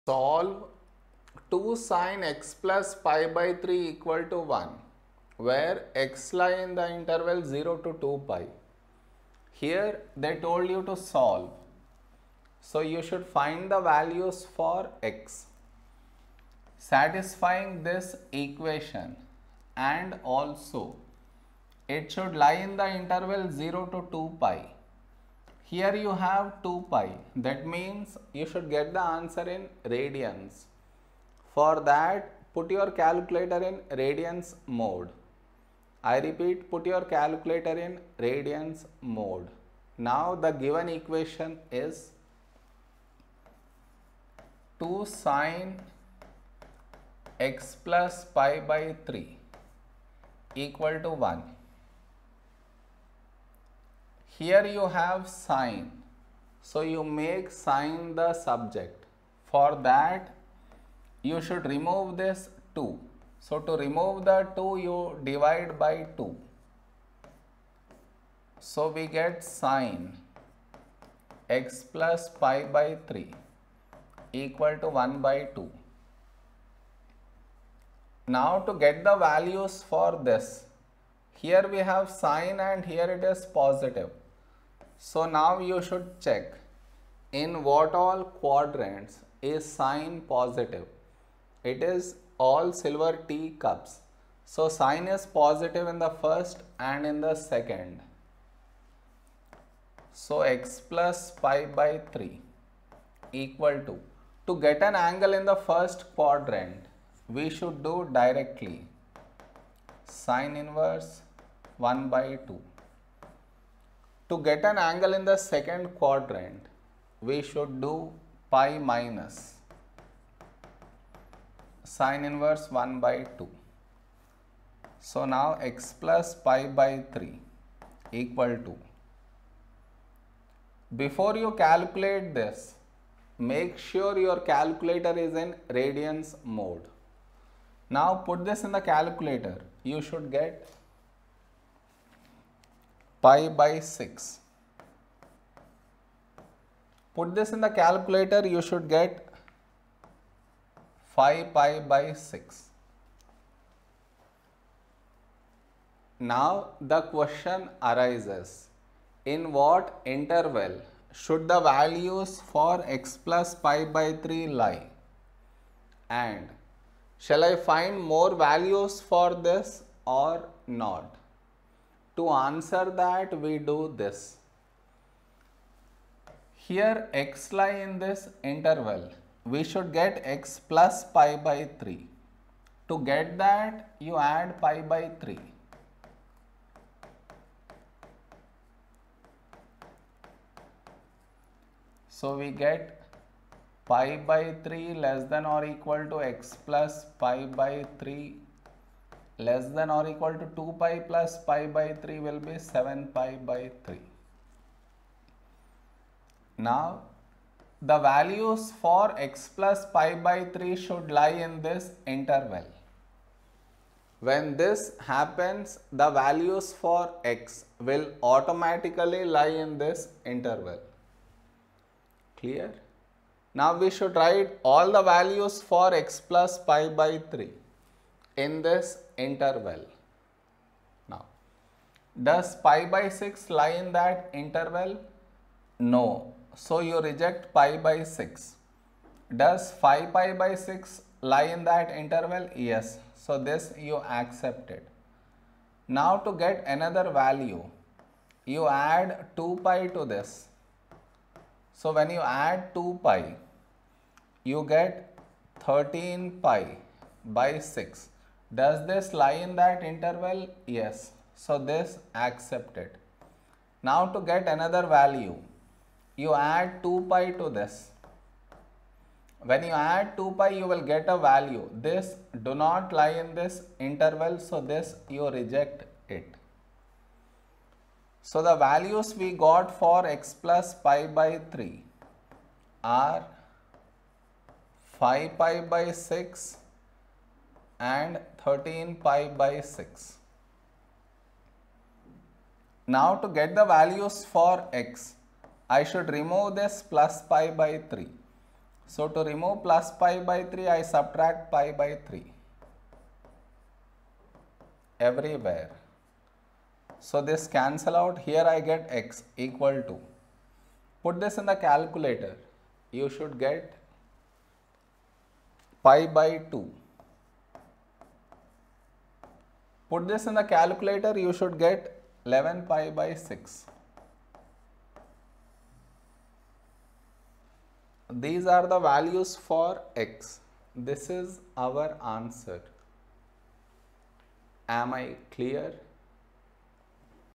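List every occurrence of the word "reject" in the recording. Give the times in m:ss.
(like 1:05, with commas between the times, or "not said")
3:57, 4:35.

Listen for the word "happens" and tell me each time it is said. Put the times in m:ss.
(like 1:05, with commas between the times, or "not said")
3:35.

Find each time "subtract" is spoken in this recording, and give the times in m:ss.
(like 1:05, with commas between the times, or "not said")
5:00.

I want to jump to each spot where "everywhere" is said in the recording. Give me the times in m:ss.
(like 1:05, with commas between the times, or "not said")
5:04.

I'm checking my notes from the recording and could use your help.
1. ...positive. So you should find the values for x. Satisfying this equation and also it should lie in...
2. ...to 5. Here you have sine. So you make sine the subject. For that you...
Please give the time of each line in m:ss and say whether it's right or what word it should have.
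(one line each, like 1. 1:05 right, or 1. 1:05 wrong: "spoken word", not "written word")
1. 0:10 wrong: "solve", not "positive"
2. 0:51 wrong: "1", not "5".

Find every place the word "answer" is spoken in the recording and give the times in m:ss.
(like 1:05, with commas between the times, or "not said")
0:29, 2:52, 5:32.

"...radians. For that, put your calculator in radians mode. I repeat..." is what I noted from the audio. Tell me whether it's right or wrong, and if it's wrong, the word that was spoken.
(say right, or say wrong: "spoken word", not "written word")
right.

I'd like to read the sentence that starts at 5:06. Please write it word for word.
So this cancel out, here I get x equal to.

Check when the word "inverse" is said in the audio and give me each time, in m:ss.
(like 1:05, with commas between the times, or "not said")
1:50, 2:02.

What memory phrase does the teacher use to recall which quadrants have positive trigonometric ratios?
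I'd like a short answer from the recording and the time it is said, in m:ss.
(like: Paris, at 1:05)
All silver tea cups, at 1:32.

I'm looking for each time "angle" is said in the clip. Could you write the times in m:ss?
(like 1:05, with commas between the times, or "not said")
1:44, 1:54.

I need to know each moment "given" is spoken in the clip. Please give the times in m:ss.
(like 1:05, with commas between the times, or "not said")
0:40.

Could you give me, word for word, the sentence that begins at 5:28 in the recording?
These are the values for x.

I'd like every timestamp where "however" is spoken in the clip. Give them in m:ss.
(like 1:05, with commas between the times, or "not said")
not said.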